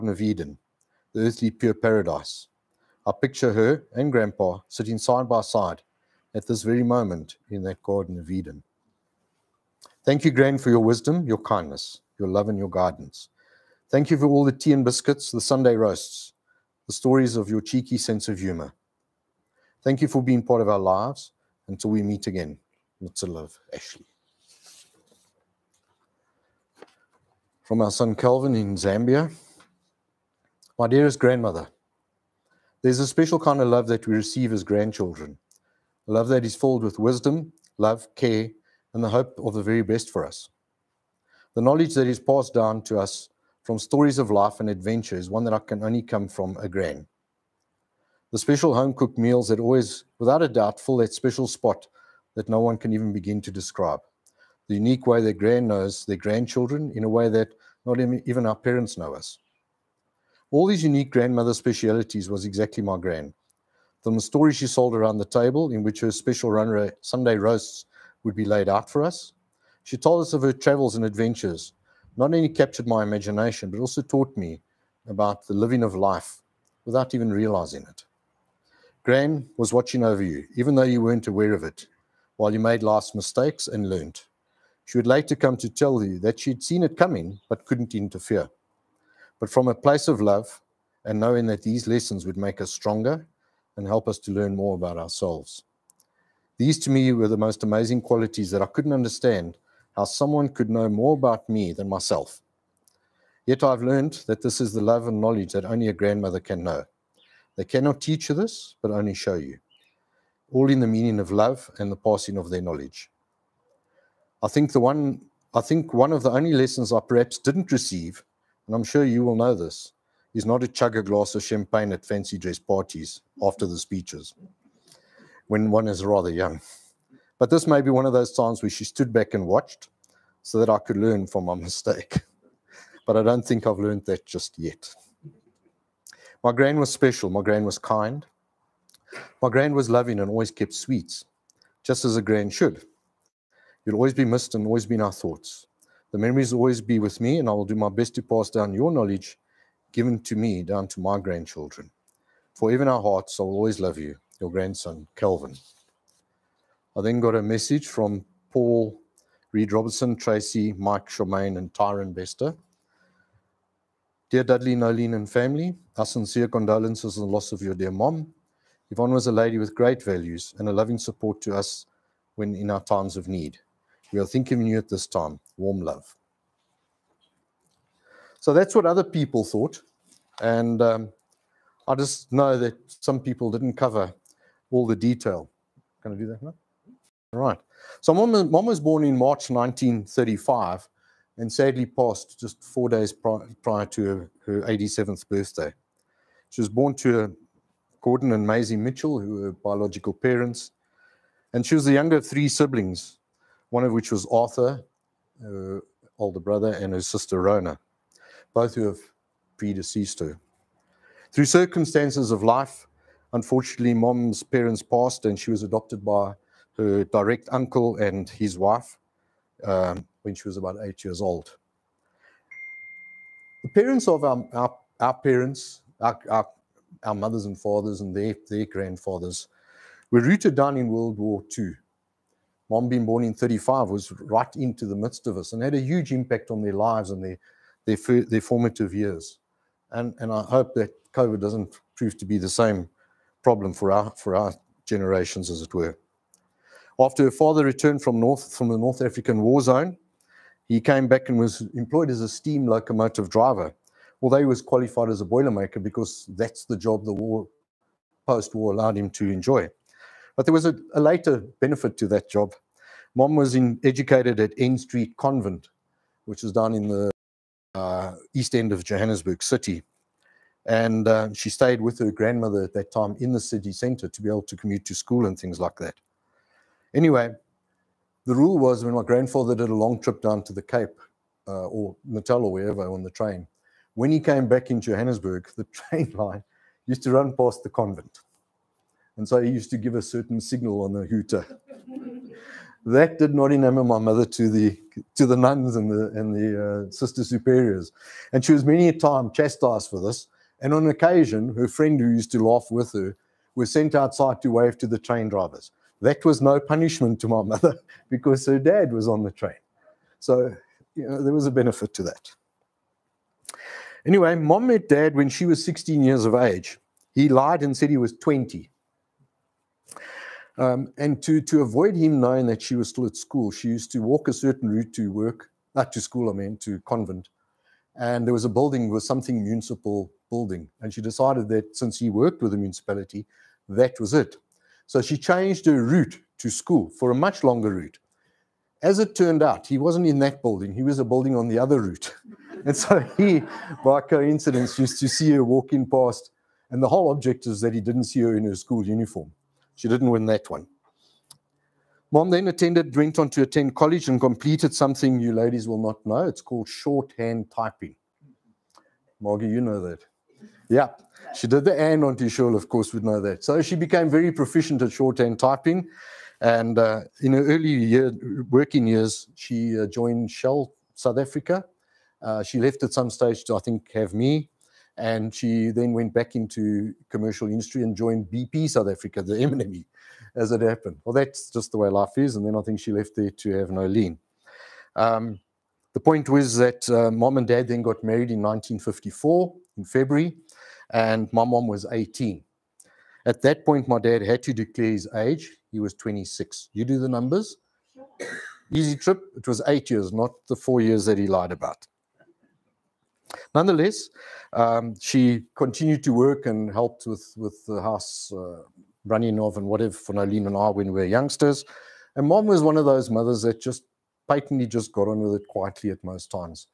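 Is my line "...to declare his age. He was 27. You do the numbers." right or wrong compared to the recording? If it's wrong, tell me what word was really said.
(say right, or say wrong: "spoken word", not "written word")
wrong: "26", not "27".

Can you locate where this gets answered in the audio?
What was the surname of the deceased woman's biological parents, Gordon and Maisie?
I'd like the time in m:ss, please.
3:18.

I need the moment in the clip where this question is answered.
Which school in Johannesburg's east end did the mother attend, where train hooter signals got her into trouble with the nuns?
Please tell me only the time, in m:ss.
4:24.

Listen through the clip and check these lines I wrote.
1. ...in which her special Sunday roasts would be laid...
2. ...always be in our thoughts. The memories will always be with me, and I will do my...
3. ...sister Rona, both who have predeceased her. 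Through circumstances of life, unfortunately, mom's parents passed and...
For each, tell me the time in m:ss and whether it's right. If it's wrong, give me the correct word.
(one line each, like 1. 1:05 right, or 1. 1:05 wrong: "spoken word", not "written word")
1. 1:05 right
2. 2:24 right
3. 3:27 right.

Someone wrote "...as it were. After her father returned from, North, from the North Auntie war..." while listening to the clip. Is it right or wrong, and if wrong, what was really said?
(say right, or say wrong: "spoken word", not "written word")
wrong: "African", not "Auntie".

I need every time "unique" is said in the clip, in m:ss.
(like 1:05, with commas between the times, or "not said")
0:54, 1:00.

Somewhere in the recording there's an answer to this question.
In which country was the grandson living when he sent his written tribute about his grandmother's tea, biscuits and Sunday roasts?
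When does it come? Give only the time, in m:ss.
0:28.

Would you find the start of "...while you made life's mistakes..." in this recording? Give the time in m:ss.
1:22.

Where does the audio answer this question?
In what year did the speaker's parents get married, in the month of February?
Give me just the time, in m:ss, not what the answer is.
6:28.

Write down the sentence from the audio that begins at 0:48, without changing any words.
The special home cooked meals that always, without a doubt, fill that special spot that no one can even begin to describe.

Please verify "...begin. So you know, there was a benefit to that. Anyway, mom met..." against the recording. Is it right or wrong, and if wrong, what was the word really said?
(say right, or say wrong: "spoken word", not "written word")
wrong: "train", not "begin".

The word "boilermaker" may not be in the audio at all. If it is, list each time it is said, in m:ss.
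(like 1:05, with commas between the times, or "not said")
4:15.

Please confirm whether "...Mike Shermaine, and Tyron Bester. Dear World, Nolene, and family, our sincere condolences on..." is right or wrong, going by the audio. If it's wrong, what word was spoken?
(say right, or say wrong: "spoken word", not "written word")
wrong: "Dudley", not "World".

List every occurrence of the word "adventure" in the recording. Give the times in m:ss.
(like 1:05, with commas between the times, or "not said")
0:44, 1:11.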